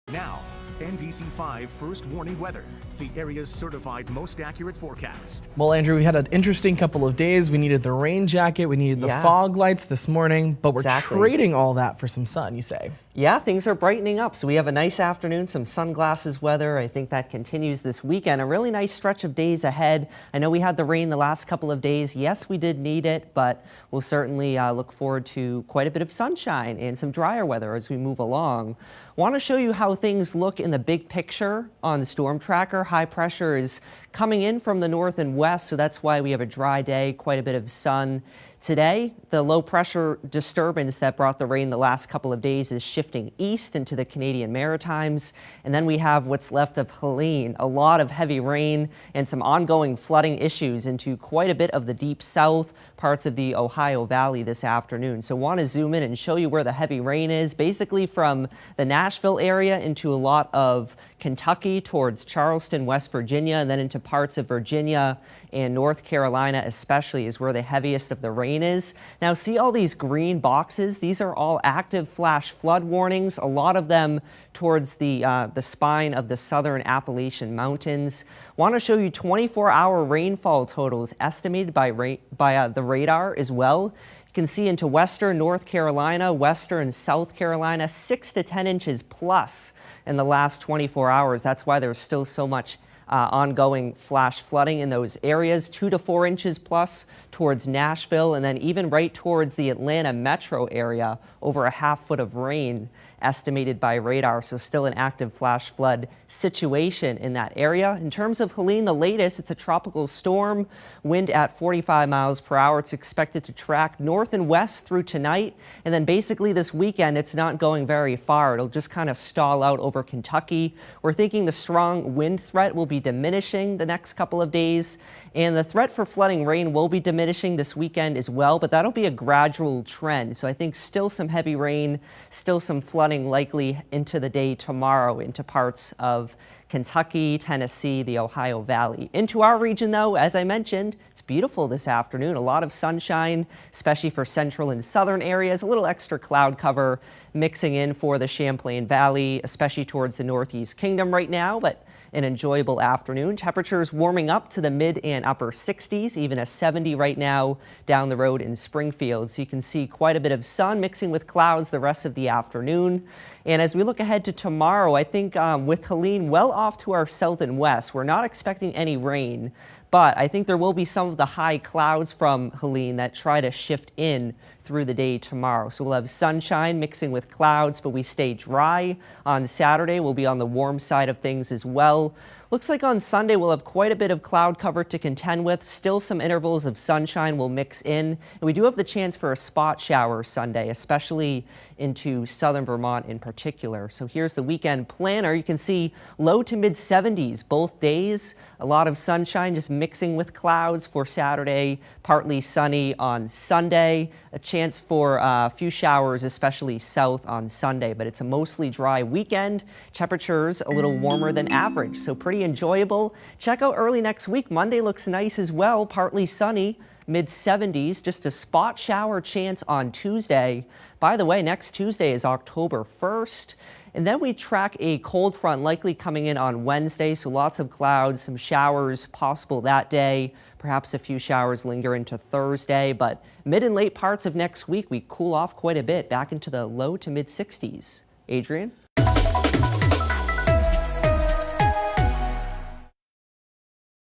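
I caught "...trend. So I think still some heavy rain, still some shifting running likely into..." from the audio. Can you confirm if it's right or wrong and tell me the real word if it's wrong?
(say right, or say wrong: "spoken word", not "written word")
wrong: "flooding", not "shifting".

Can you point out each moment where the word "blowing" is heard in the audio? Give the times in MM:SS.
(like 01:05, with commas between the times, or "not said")
not said.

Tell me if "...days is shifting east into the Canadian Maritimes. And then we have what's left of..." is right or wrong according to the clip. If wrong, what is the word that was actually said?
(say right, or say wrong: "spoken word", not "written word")
right.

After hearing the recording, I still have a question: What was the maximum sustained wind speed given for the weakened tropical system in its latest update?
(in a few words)
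45 mph.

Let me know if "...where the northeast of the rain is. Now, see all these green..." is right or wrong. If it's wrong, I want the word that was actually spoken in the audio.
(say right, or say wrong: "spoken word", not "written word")
wrong: "heaviest", not "northeast".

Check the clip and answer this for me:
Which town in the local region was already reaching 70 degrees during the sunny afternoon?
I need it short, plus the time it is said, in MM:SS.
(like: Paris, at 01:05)
Springfield, at 02:38.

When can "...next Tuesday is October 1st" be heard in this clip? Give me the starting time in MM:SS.
03:41.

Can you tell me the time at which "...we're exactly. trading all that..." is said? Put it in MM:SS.
00:10.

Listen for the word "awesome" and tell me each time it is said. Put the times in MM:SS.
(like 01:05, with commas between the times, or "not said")
not said.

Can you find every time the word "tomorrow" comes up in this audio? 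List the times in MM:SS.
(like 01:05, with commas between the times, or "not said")
02:14, 02:44, 02:55.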